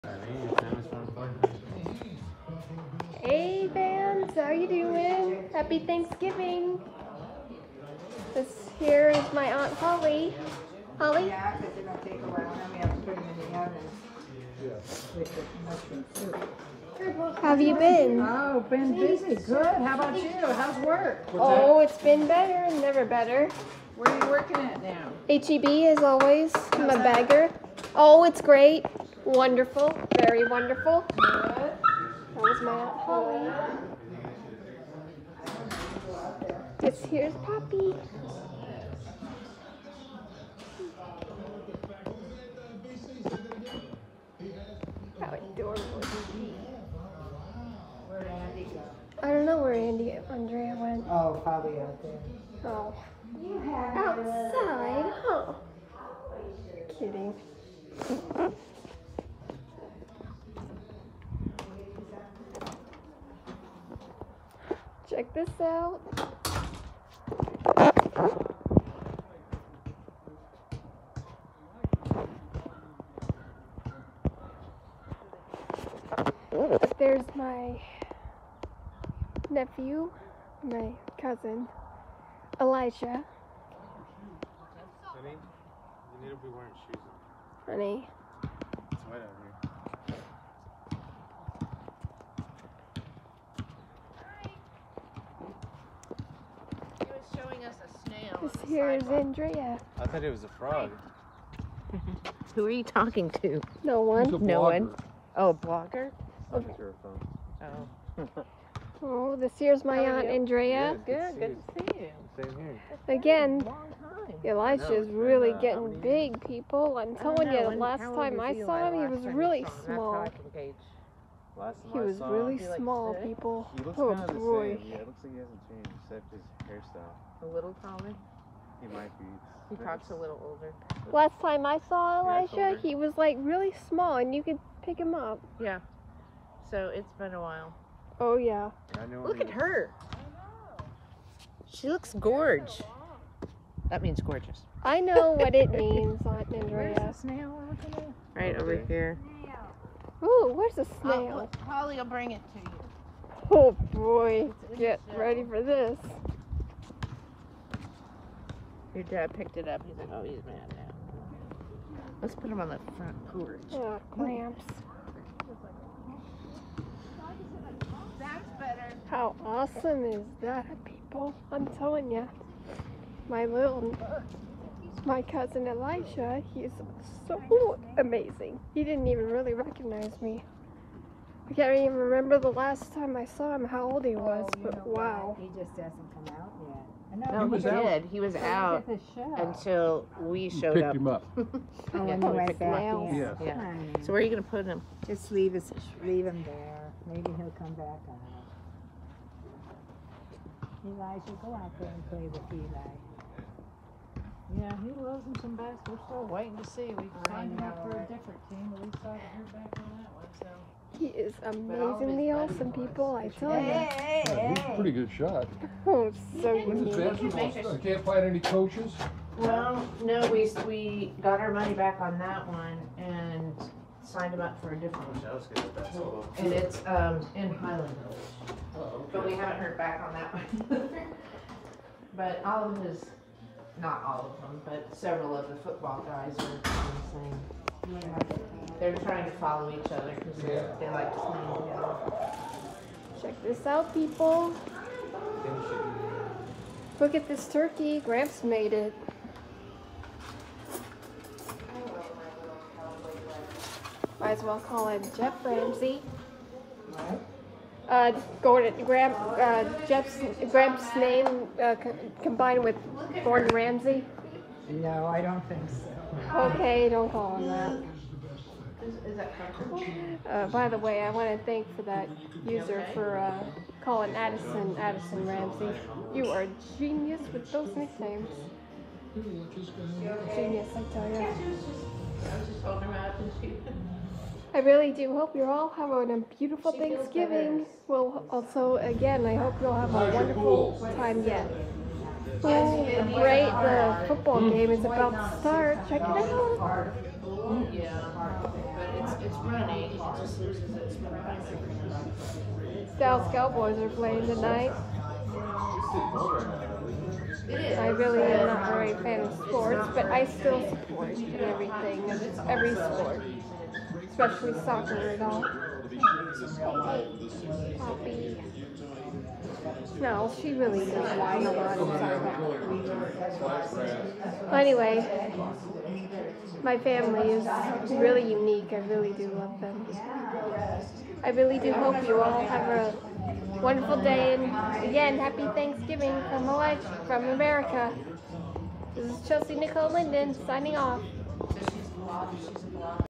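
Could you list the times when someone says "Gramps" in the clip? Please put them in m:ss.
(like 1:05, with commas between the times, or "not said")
4:07, 4:20.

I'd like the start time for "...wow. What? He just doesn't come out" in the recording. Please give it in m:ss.
3:04.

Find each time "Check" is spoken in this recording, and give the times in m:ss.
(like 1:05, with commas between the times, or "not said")
1:05, 4:03, 4:55.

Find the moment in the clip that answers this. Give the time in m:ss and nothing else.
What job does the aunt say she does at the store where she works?
0:26.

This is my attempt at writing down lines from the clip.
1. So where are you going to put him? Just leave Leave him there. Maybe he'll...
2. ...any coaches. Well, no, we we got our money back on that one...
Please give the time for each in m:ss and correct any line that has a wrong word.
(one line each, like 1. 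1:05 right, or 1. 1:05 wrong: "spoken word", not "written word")
1. 3:14 right
2. 3:38 right.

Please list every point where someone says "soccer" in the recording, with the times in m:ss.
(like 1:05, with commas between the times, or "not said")
5:14, 5:23.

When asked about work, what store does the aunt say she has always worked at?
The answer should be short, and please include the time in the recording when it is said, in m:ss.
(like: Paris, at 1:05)
HEB, at 0:25.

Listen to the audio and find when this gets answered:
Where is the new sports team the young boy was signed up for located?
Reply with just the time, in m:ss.
3:47.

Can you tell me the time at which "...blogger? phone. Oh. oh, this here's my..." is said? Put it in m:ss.
1:45.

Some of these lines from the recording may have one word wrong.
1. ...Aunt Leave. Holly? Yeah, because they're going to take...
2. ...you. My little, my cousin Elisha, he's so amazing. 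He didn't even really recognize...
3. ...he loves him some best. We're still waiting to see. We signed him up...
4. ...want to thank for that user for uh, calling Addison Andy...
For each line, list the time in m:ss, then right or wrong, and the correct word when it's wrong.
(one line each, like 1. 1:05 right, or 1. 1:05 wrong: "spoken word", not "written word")
1. 0:09 wrong: "Holly", not "Leave"
2. 2:52 right
3. 3:24 right
4. 4:31 wrong: "Addison", not "Andy".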